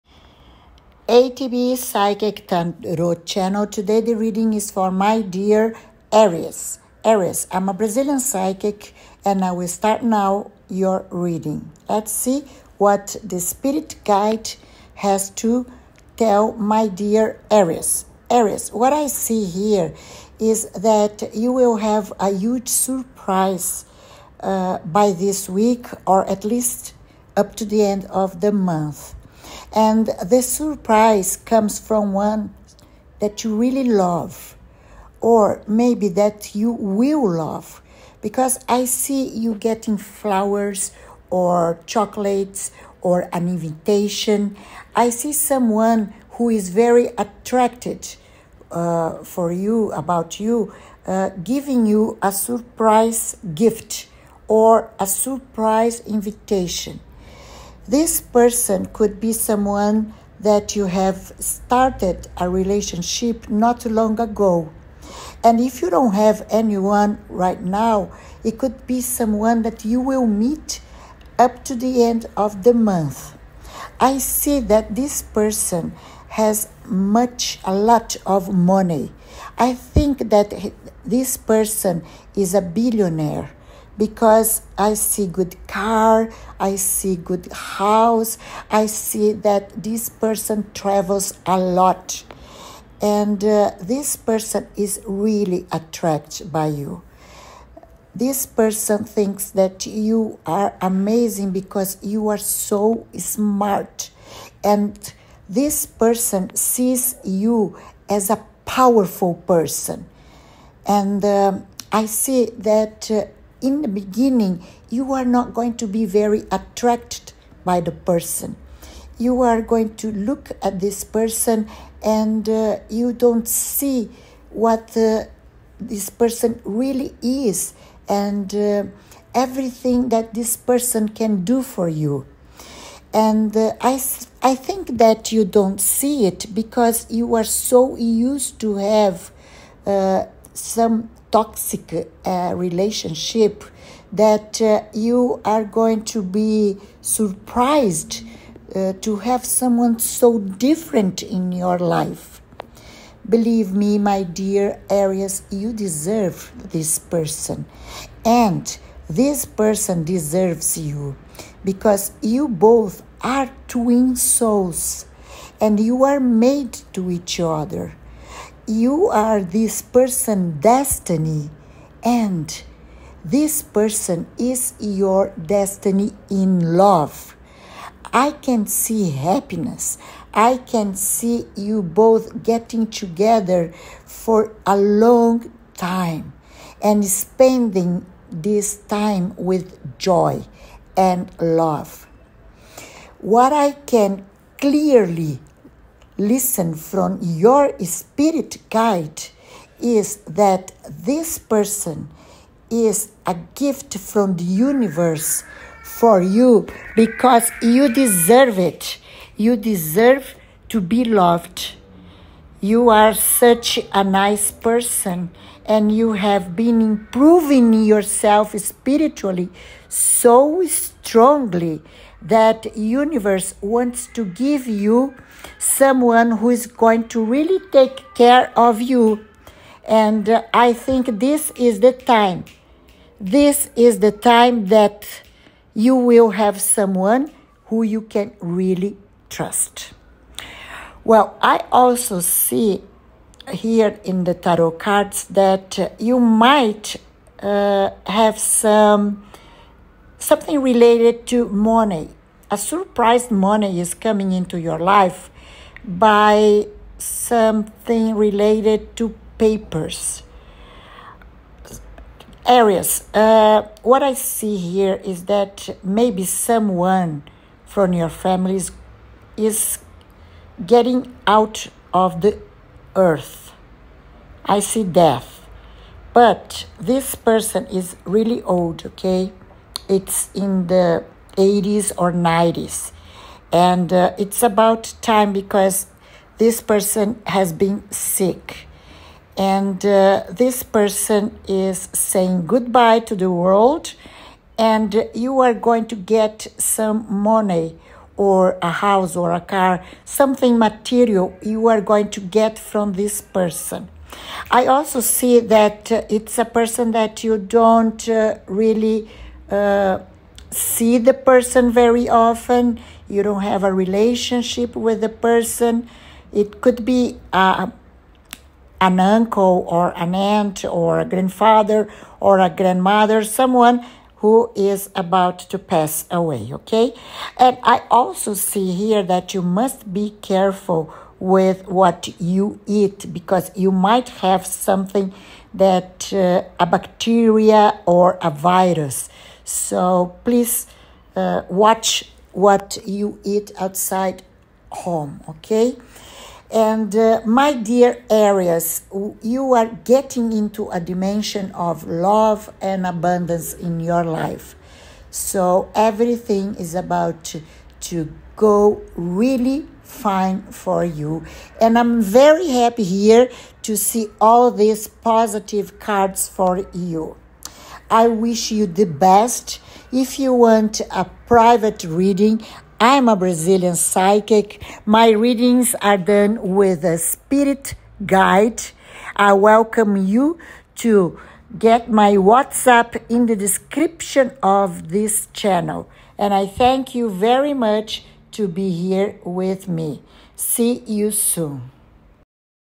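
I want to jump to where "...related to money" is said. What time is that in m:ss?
4:10.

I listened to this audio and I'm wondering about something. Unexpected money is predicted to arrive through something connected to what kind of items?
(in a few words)
papers.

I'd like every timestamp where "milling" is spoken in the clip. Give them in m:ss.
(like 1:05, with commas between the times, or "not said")
not said.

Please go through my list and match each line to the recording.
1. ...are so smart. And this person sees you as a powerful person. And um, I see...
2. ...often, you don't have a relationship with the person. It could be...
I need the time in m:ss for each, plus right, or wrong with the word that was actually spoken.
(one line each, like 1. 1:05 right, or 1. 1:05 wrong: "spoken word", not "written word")
1. 1:42 right
2. 5:12 right.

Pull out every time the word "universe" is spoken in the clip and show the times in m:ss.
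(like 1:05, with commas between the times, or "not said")
3:24, 3:42.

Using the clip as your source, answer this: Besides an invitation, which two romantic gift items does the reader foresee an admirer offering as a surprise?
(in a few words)
flowers or chocolates.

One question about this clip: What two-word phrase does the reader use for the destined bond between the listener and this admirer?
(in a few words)
twin souls.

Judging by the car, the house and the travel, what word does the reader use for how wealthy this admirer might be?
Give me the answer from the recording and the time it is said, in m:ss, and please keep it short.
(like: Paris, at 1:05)
billionaire, at 1:22.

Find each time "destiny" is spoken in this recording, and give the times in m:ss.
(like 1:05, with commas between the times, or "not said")
2:50, 2:55.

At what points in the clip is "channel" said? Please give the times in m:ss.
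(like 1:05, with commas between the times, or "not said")
0:03, 6:25.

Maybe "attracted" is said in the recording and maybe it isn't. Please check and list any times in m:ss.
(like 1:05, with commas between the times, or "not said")
0:47, 1:35, 1:56.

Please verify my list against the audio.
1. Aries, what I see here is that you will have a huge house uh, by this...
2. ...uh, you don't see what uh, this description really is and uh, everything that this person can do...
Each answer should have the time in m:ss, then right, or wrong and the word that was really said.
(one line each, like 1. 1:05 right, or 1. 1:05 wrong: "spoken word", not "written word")
1. 0:18 wrong: "surprise", not "house"
2. 2:02 wrong: "person", not "description".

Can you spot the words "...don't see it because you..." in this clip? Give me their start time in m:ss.
2:15.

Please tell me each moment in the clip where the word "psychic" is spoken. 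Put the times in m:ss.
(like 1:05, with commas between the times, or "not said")
0:01, 0:08, 6:13.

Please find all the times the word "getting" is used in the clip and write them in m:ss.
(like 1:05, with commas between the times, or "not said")
0:39, 3:02, 4:30, 5:49.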